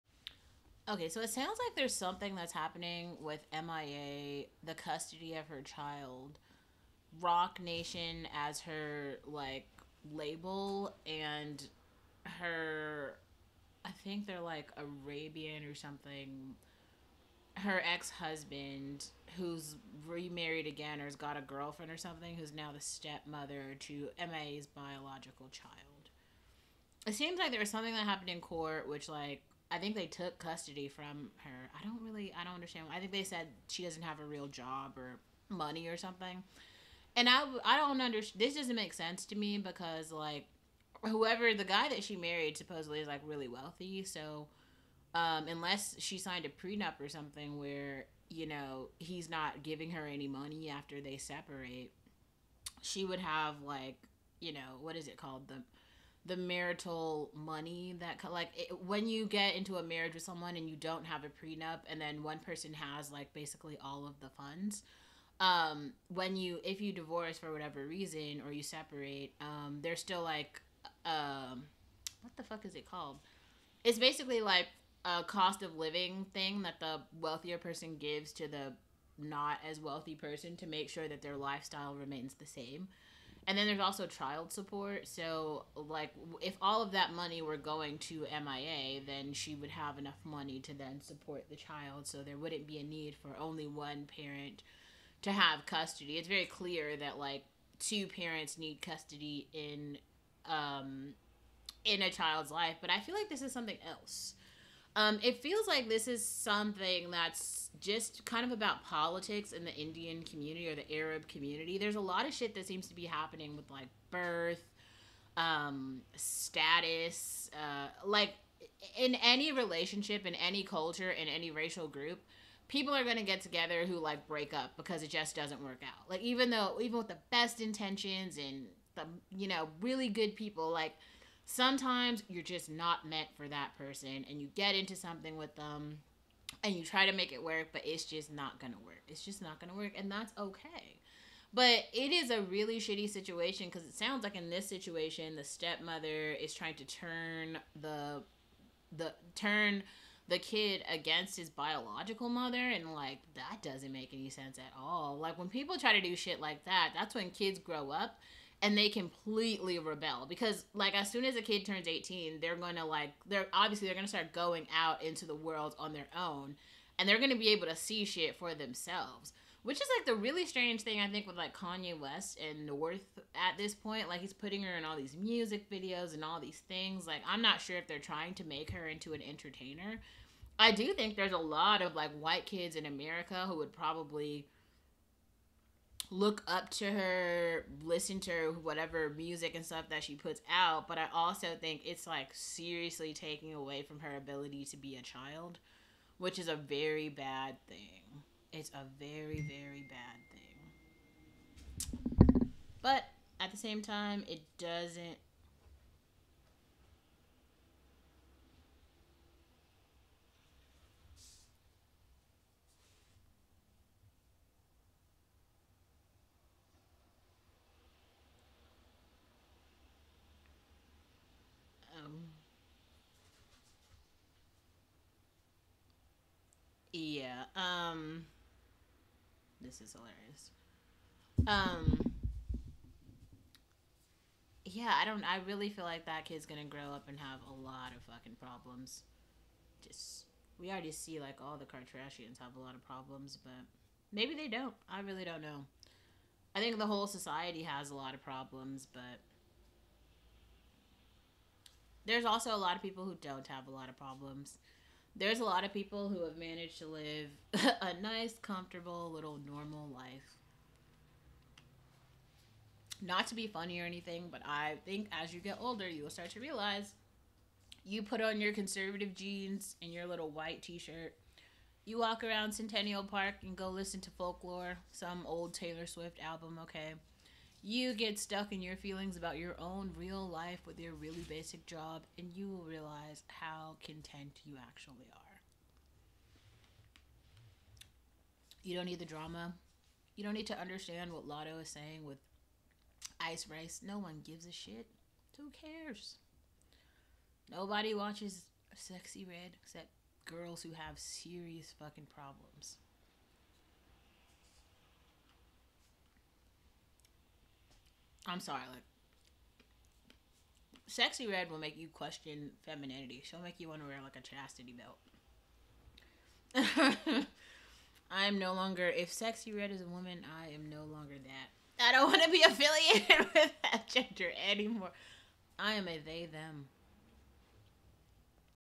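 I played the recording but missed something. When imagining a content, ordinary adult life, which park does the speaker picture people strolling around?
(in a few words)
Centennial Park.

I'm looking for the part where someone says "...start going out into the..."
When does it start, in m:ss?
2:44.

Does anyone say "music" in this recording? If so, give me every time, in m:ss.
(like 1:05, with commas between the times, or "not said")
2:55, 3:09.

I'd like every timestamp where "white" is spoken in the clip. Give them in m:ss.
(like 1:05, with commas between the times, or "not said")
3:02, 4:30.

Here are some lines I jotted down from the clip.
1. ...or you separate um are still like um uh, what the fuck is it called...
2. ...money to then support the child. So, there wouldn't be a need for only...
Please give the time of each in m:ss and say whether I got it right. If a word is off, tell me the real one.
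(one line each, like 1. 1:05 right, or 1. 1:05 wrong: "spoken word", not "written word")
1. 1:08 right
2. 1:30 right.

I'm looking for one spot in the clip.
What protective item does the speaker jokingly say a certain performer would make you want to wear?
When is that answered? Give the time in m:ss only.
5:14.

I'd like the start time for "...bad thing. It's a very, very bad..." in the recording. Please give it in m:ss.
3:17.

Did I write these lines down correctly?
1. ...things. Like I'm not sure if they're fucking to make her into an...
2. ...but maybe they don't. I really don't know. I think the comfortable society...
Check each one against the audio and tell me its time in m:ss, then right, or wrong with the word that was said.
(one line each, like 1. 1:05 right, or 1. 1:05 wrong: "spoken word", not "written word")
1. 2:56 wrong: "trying", not "fucking"
2. 4:03 wrong: "whole", not "comfortable".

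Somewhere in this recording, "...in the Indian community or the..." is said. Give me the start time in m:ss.
1:49.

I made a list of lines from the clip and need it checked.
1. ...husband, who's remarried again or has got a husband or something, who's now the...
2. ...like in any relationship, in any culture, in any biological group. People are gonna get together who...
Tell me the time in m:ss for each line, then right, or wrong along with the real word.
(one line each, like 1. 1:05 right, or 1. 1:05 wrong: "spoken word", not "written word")
1. 0:18 wrong: "girlfriend", not "husband"
2. 1:58 wrong: "racial", not "biological".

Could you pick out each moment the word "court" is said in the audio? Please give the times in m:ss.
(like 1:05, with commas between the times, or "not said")
0:28.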